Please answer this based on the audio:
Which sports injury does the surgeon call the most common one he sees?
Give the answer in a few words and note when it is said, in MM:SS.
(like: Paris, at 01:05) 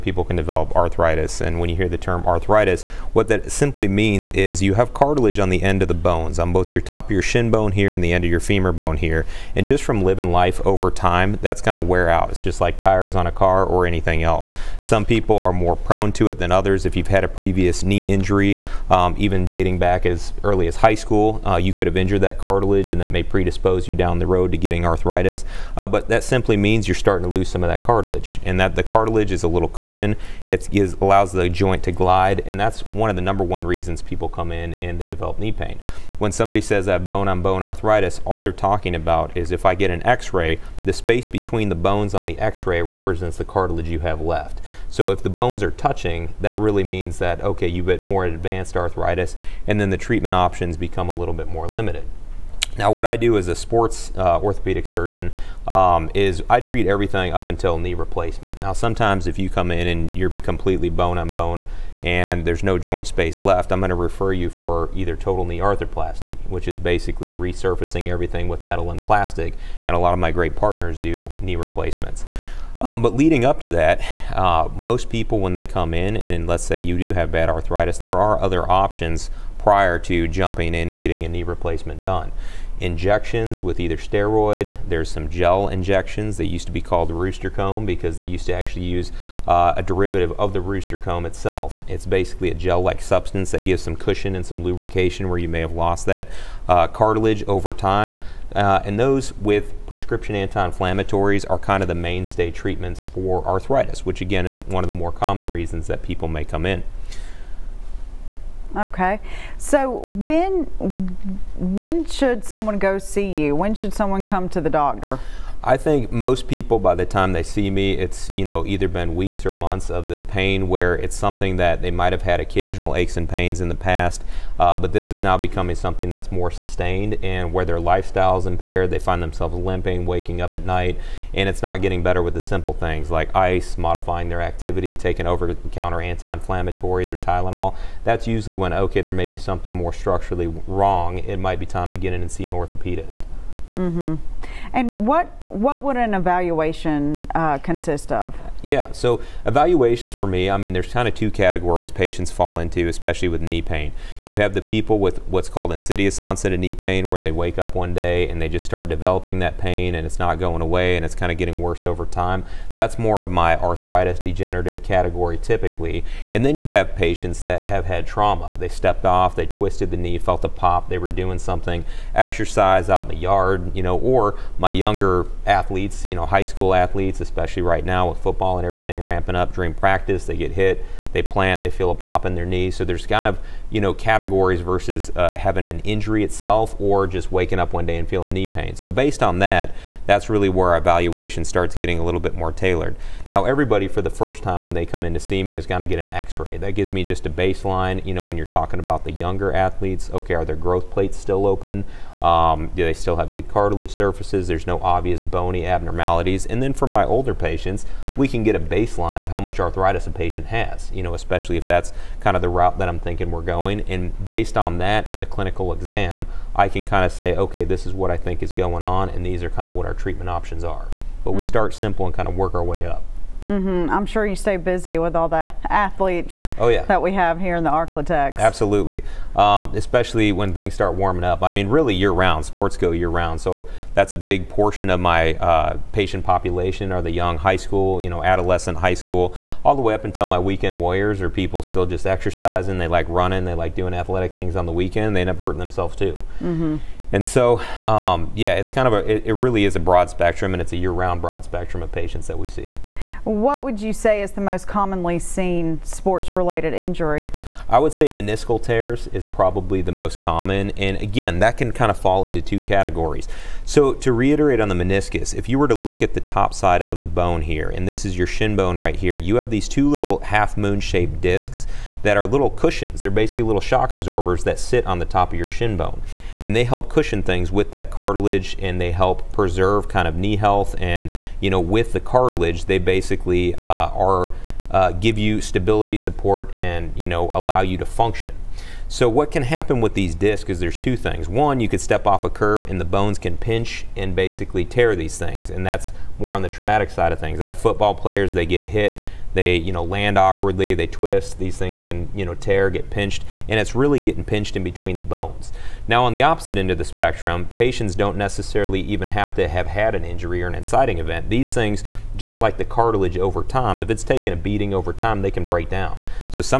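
Meniscal tears, at 04:18.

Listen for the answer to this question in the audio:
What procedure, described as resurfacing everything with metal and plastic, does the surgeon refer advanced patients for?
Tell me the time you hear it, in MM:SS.
01:05.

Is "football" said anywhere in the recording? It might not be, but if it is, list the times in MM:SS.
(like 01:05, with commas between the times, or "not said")
02:58, 04:57.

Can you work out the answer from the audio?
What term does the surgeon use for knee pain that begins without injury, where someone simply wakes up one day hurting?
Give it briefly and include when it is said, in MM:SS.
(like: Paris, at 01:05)
Insidious onset, at 02:35.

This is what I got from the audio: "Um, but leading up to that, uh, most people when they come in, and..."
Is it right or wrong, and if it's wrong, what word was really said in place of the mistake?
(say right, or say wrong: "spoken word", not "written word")
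right.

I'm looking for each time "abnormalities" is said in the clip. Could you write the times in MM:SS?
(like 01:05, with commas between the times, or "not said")
03:25.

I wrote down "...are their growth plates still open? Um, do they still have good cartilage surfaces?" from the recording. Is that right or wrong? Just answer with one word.
right.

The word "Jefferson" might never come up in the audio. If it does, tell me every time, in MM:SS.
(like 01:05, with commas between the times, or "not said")
not said.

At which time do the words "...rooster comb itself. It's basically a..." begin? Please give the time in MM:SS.
01:30.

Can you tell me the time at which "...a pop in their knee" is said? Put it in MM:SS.
03:01.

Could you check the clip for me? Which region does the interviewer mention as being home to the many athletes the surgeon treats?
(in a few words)
Arklatex.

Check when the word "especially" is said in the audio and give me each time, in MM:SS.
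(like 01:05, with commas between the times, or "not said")
02:32, 02:57, 03:31, 03:49.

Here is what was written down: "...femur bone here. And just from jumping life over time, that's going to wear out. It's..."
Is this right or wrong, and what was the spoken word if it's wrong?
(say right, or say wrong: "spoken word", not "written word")
wrong: "living", not "jumping".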